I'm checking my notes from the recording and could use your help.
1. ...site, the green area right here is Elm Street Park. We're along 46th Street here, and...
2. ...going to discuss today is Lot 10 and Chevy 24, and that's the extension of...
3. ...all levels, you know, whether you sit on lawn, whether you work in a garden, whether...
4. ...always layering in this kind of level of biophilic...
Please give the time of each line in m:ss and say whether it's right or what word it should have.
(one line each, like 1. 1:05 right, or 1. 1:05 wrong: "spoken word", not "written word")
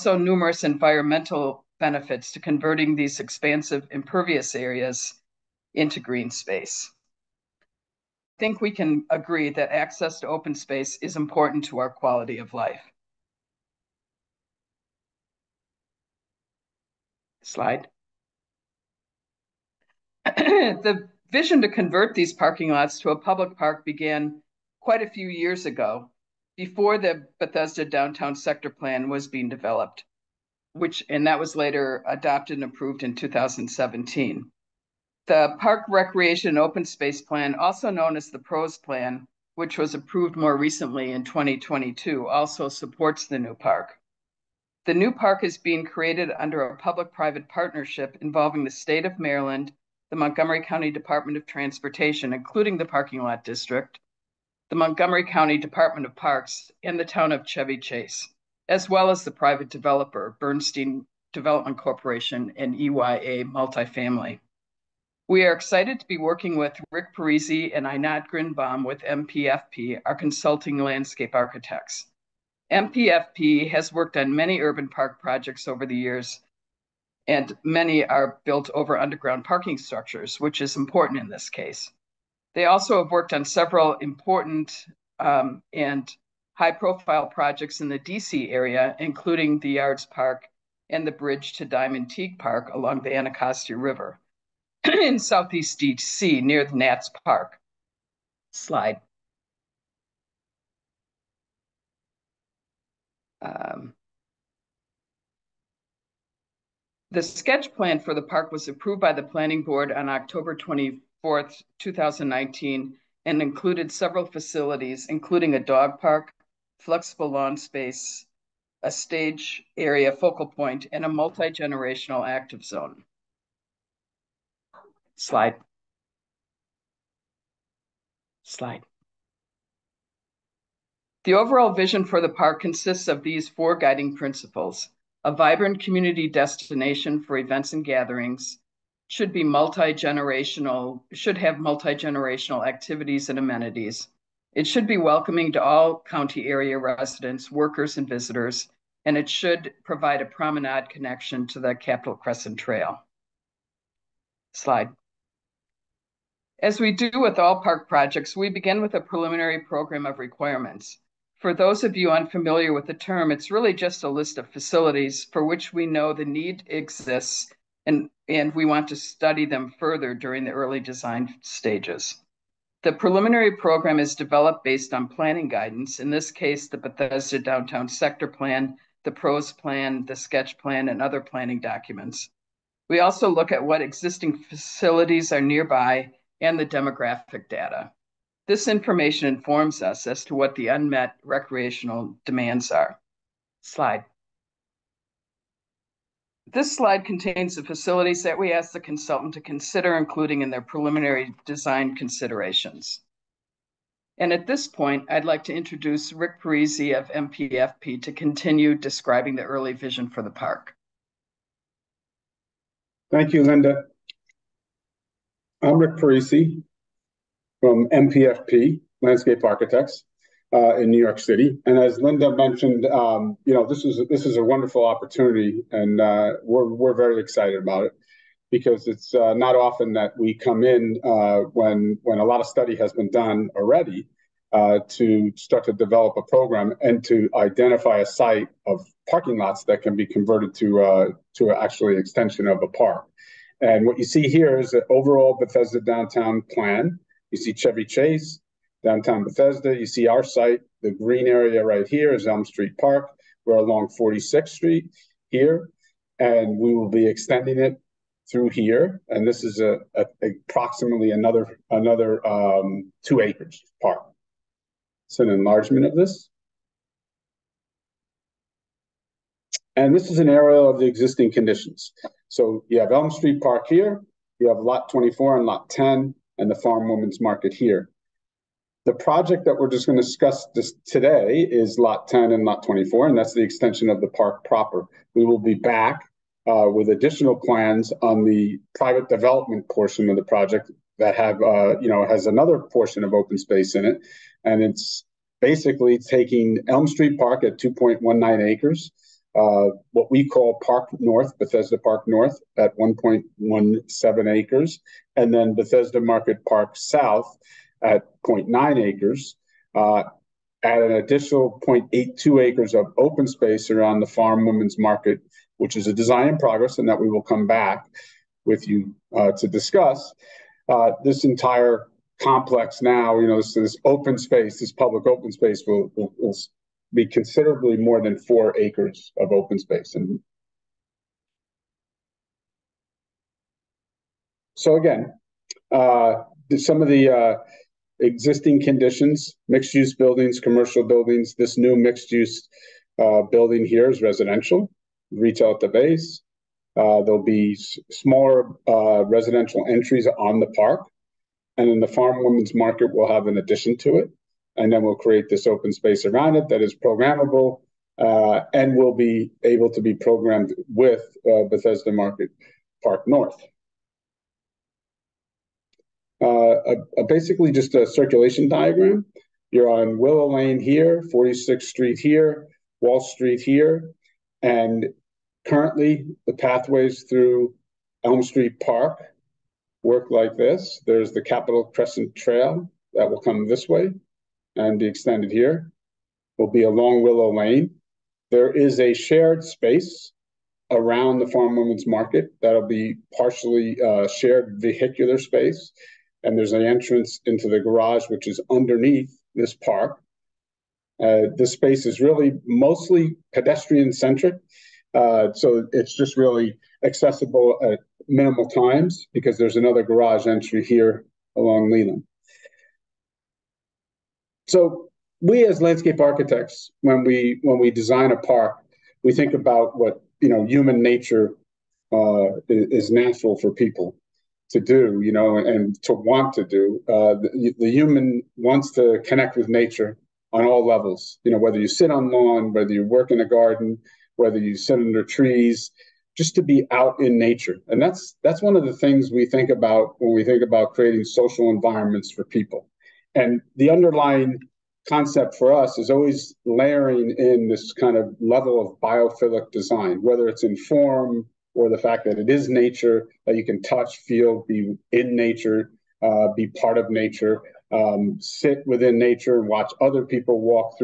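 1. 4:10 right
2. 4:39 wrong: "Lot", not "Chevy"
3. 7:10 right
4. 7:25 right.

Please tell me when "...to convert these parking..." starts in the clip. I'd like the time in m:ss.
0:21.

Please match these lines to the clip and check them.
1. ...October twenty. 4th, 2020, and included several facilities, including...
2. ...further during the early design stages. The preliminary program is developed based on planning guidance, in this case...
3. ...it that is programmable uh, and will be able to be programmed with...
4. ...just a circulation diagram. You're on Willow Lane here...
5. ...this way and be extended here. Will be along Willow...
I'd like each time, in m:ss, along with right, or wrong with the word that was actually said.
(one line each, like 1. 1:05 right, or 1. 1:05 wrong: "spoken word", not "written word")
1. 1:50 wrong: "2019", not "2020"
2. 2:49 right
3. 5:56 right
4. 6:07 right
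5. 6:23 right.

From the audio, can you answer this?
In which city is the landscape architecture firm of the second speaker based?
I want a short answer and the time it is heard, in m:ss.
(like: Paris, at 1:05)
New York City, at 3:40.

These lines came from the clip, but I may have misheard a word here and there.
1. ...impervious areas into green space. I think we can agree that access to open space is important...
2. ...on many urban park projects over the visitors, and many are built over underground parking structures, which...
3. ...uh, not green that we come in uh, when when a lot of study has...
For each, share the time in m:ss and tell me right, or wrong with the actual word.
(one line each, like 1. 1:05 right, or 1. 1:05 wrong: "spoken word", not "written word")
1. 0:03 right
2. 1:14 wrong: "years", not "visitors"
3. 3:49 wrong: "often", not "green".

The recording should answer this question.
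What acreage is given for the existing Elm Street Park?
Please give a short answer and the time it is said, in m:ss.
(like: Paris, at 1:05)
2.19 acres, at 4:57.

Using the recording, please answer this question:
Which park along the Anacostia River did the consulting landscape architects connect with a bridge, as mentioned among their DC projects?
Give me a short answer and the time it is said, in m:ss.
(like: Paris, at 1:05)
Diamond Teague Park, at 1:31.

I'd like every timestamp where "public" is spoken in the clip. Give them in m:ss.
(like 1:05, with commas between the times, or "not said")
0:23, 0:46, 5:24.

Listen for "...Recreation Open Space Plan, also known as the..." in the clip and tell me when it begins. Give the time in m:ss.
0:35.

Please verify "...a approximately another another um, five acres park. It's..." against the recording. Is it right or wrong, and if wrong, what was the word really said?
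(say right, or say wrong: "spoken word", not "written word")
wrong: "two", not "five".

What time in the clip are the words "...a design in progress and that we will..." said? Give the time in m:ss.
5:15.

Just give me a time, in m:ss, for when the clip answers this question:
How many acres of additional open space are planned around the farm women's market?
5:11.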